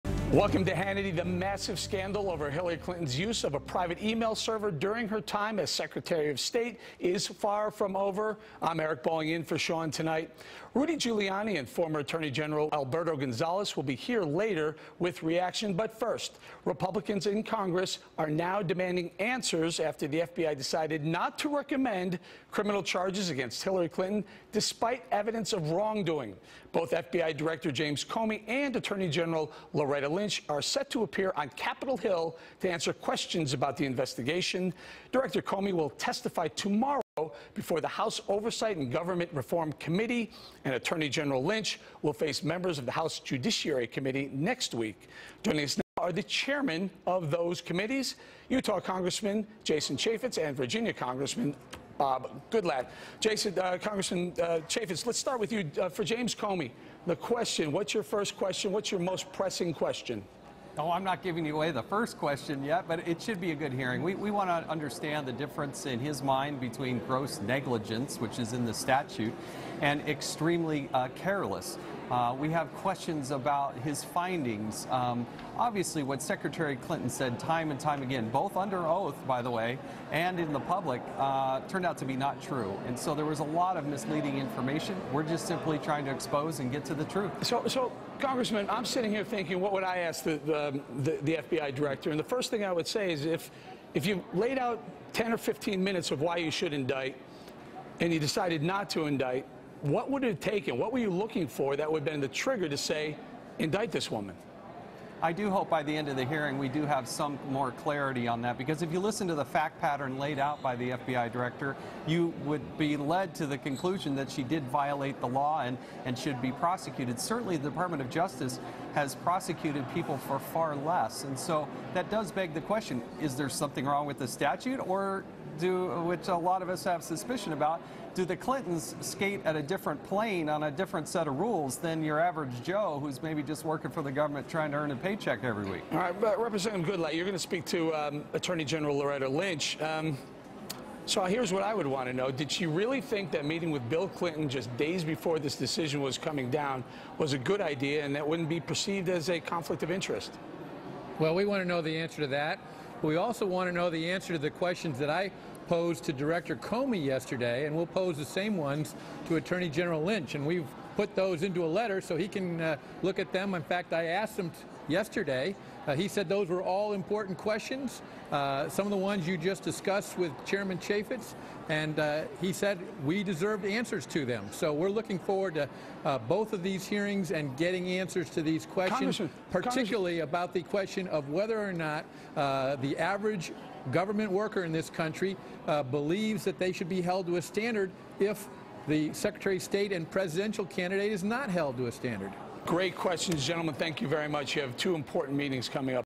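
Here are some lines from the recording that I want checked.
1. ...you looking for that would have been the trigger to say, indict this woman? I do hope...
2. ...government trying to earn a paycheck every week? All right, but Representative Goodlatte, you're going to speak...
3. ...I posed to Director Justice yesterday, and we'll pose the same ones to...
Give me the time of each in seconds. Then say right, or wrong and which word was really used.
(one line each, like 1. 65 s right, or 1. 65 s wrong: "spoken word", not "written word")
1. 100 s right
2. 134 s right
3. 155 s wrong: "Comey", not "Justice".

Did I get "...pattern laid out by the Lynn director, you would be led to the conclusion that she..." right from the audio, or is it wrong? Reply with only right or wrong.
wrong.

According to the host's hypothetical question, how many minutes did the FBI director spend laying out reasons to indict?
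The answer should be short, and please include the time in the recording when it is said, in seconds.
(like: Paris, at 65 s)
10 or 15, at 95 s.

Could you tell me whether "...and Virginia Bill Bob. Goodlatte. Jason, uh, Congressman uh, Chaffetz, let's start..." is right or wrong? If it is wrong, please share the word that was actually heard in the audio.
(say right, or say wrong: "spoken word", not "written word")
wrong: "Congressman", not "Bill".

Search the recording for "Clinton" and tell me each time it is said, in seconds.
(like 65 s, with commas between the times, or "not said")
2 s, 23 s, 76 s, 128 s, 144 s.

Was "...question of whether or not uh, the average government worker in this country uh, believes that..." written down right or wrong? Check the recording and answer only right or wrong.
right.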